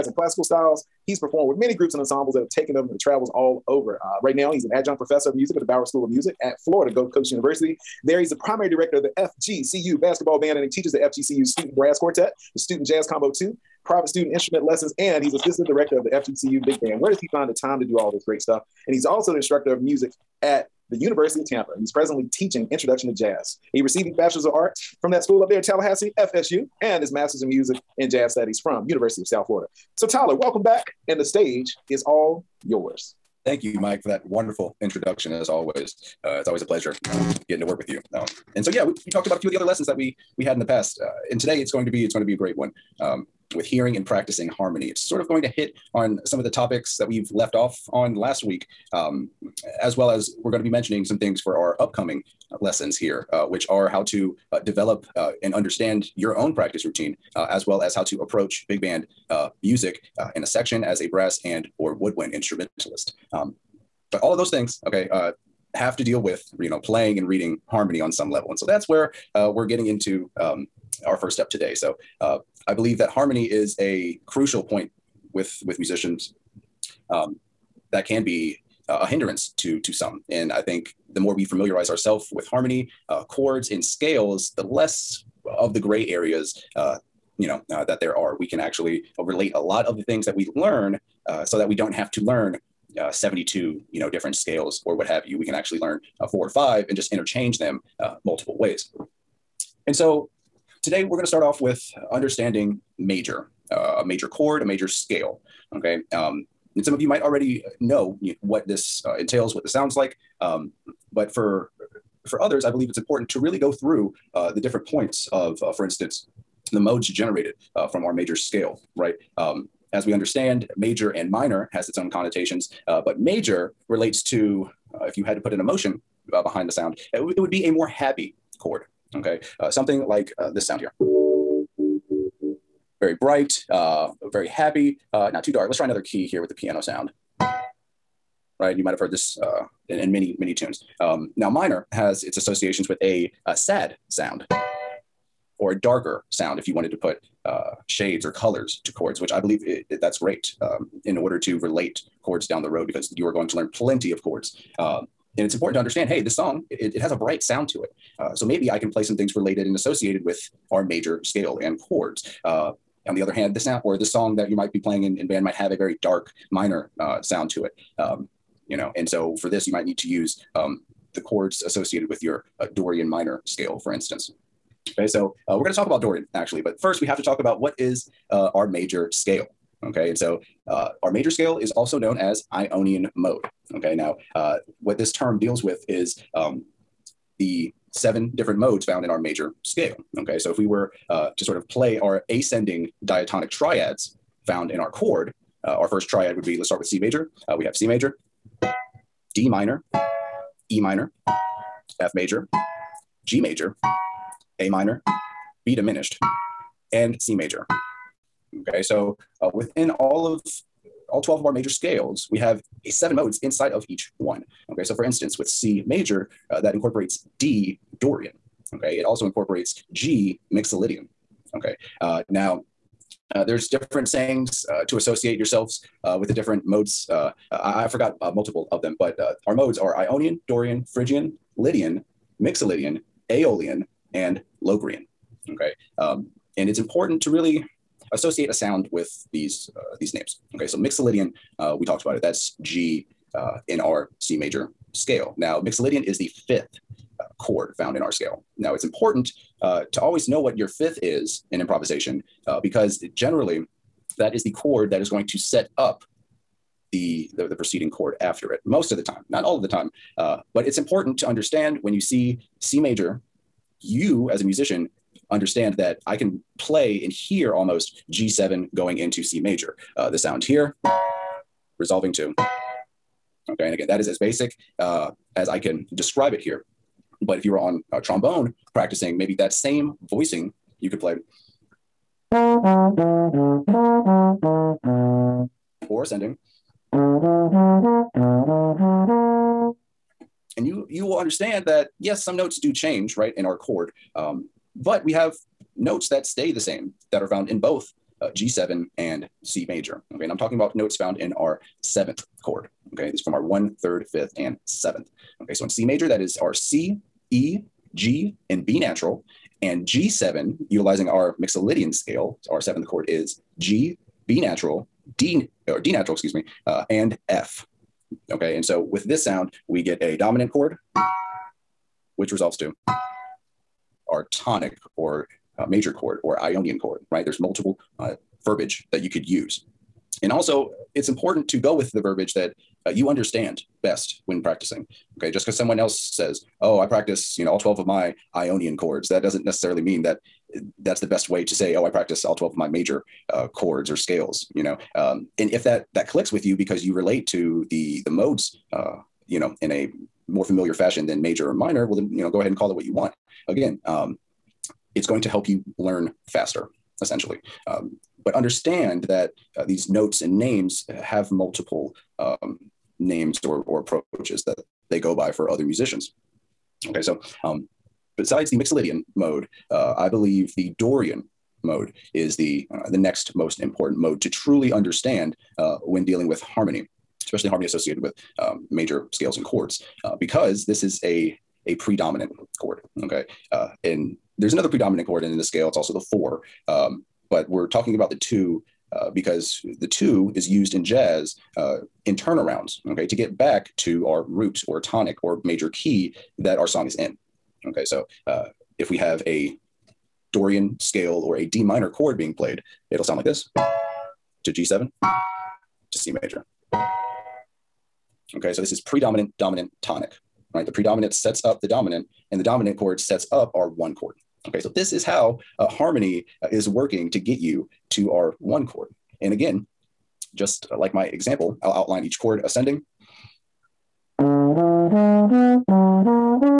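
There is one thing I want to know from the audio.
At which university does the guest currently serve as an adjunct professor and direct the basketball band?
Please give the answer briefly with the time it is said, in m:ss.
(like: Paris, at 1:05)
Florida Gulf Coast University, at 0:06.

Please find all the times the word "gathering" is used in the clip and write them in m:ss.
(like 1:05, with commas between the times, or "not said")
not said.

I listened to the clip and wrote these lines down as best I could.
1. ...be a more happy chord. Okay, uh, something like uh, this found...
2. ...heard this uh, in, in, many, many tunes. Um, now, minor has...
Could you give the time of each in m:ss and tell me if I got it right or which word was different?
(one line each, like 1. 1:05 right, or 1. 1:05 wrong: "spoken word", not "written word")
1. 2:07 wrong: "sound", not "found"
2. 2:18 right.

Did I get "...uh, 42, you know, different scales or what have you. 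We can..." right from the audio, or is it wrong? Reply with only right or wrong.
wrong.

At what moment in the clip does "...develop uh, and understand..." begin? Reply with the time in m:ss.
0:54.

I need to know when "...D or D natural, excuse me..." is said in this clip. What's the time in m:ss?
5:15.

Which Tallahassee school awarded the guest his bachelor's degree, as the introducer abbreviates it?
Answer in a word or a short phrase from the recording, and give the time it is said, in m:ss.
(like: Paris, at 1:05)
FSU, at 0:26.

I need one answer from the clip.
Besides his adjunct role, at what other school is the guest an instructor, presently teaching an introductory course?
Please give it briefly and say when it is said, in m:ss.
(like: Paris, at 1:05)
University of Tampa, at 0:20.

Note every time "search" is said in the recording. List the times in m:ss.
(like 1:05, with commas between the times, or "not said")
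not said.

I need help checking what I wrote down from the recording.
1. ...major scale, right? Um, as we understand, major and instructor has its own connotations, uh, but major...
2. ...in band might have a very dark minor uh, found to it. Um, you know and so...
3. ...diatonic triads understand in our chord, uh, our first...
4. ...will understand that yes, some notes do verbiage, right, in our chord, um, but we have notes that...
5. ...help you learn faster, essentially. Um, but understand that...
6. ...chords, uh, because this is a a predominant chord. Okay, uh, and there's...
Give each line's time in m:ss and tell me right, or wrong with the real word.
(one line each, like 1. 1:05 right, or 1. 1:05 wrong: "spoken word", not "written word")
1. 1:58 wrong: "minor", not "instructor"
2. 2:45 wrong: "sound", not "found"
3. 3:13 wrong: "found", not "understand"
4. 4:51 wrong: "change", not "verbiage"
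5. 5:55 right
6. 6:19 right.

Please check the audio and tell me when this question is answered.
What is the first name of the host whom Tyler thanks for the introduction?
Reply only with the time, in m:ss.
0:33.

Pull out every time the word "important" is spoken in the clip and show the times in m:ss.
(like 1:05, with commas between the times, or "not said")
1:52, 2:35, 3:56, 4:08, 4:20, 5:31, 6:13.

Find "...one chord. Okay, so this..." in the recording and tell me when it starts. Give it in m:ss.
6:53.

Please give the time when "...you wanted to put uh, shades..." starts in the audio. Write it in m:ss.
2:26.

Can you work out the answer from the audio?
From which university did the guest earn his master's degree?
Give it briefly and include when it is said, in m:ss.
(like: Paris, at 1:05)
University of South Florida, at 0:28.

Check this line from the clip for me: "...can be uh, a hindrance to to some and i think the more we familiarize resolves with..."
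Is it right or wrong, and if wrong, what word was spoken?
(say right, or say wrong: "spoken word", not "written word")
wrong: "ourselves", not "resolves".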